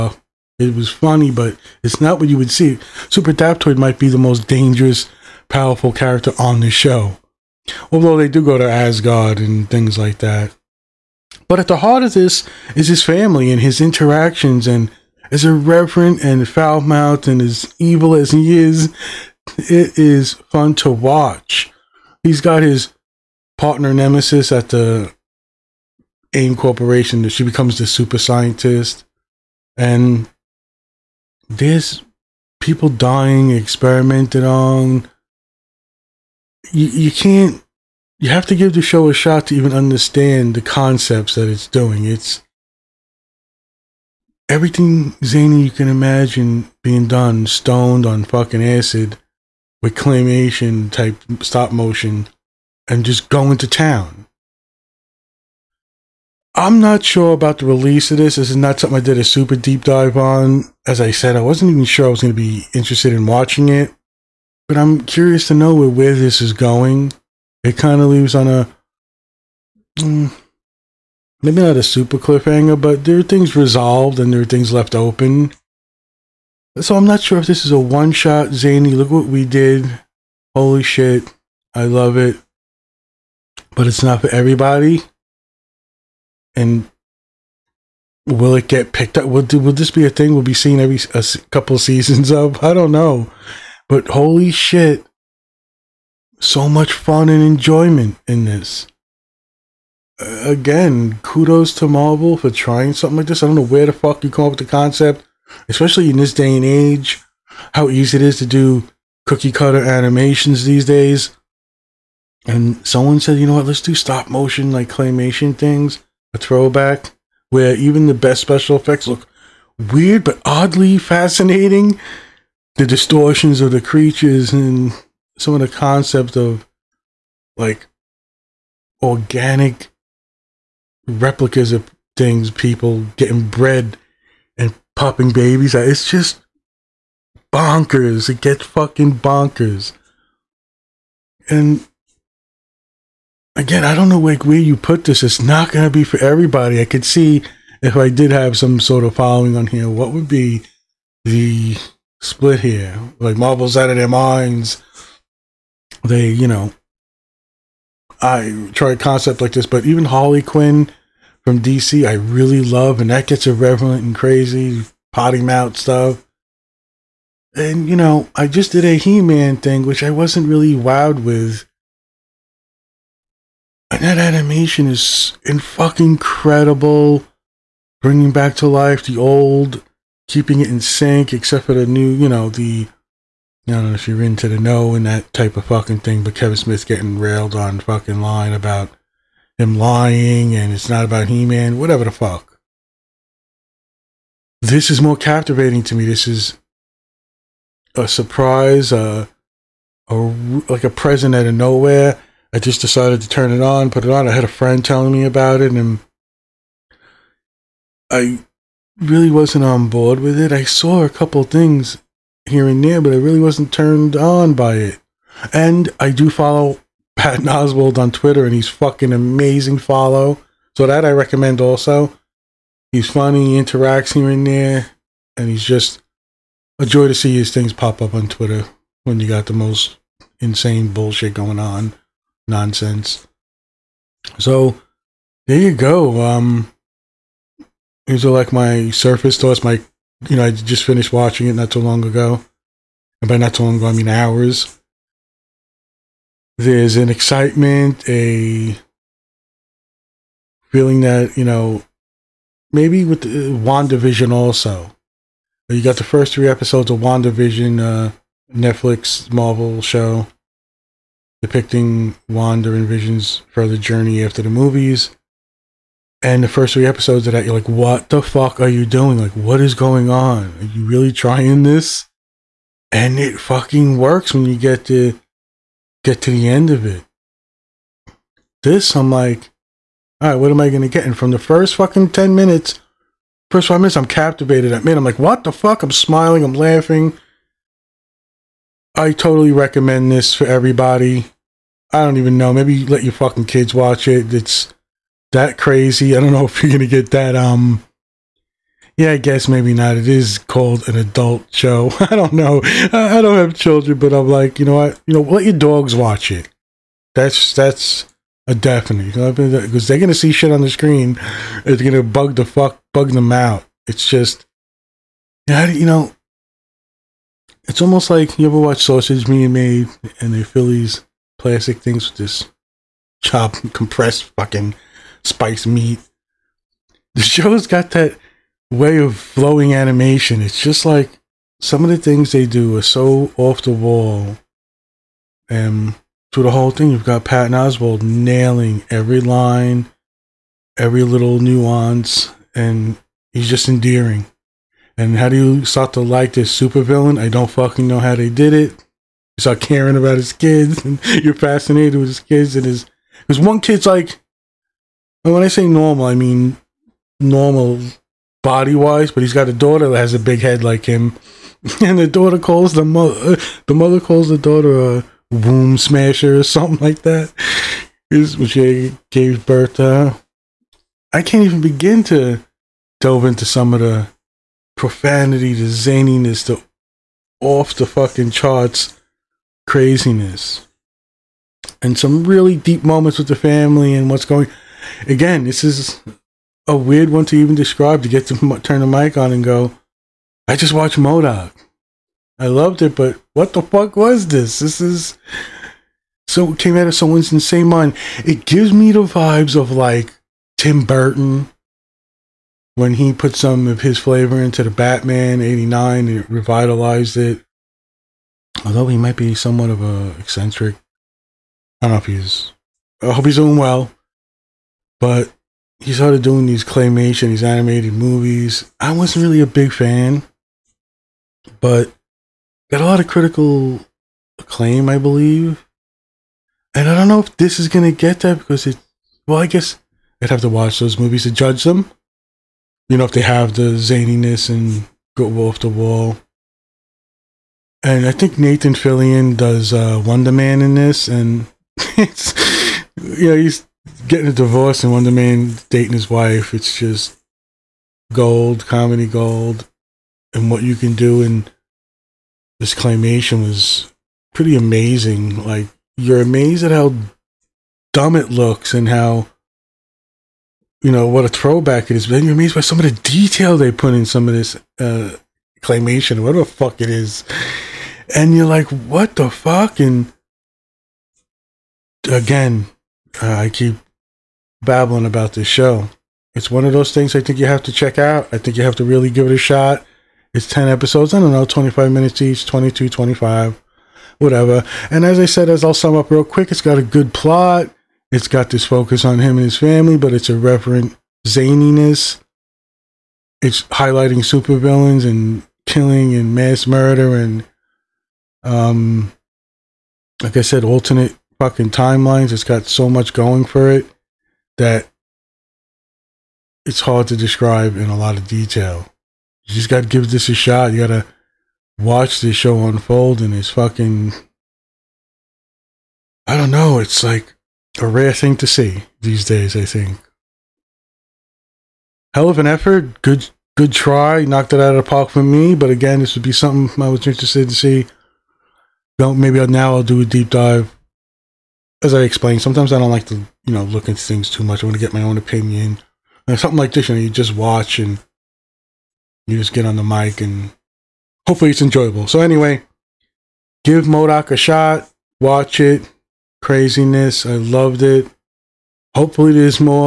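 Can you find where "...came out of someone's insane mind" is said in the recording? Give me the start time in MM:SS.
06:36.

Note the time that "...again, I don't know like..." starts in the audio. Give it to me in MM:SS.
02:23.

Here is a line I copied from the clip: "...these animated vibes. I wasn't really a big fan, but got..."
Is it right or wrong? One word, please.
wrong.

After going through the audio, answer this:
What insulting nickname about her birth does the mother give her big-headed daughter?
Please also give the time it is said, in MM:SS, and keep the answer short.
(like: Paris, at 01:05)
womb smasher, at 06:05.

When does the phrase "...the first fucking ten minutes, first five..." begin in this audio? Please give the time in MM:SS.
04:41.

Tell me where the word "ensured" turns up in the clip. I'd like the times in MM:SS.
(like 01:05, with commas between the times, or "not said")
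not said.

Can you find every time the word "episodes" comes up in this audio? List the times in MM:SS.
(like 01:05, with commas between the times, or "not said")
04:16, 04:26, 08:00.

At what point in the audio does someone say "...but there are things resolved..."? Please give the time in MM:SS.
01:12.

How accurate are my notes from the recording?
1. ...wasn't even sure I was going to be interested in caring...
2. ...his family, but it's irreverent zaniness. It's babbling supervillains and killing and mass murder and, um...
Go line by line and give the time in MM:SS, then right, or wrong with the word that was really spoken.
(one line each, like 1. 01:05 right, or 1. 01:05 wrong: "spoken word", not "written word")
1. 01:01 wrong: "watching", not "caring"
2. 08:09 wrong: "highlighting", not "babbling".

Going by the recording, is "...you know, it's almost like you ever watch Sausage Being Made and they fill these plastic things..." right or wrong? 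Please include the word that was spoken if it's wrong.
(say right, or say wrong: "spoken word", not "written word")
right.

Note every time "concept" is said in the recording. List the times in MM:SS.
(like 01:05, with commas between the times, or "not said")
00:40, 01:44, 02:05, 02:38.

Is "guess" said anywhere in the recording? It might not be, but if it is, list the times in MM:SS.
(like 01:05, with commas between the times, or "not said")
04:59, 07:09.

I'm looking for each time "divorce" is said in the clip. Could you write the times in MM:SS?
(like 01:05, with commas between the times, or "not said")
07:24.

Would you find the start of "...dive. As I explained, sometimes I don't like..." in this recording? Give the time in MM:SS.
08:50.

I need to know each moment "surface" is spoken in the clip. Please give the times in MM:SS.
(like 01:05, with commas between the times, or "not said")
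03:58.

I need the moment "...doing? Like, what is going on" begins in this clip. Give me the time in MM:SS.
04:28.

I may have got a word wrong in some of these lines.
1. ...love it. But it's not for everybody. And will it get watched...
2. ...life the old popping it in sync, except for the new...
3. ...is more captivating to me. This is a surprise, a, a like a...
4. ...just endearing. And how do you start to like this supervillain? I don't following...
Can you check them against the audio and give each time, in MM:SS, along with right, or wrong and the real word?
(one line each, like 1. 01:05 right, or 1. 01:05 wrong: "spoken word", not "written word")
1. 01:21 wrong: "picked", not "watched"
2. 02:58 wrong: "keeping", not "popping"
3. 03:14 right
4. 05:43 wrong: "fucking", not "following".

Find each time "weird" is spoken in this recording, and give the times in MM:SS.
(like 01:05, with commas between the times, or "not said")
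01:59, 06:26.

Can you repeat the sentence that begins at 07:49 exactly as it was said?
And again, uh, I keep babbling about this show.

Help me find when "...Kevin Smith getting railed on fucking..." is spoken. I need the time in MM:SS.
03:06.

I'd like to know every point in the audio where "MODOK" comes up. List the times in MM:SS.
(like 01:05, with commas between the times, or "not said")
06:30, 09:03.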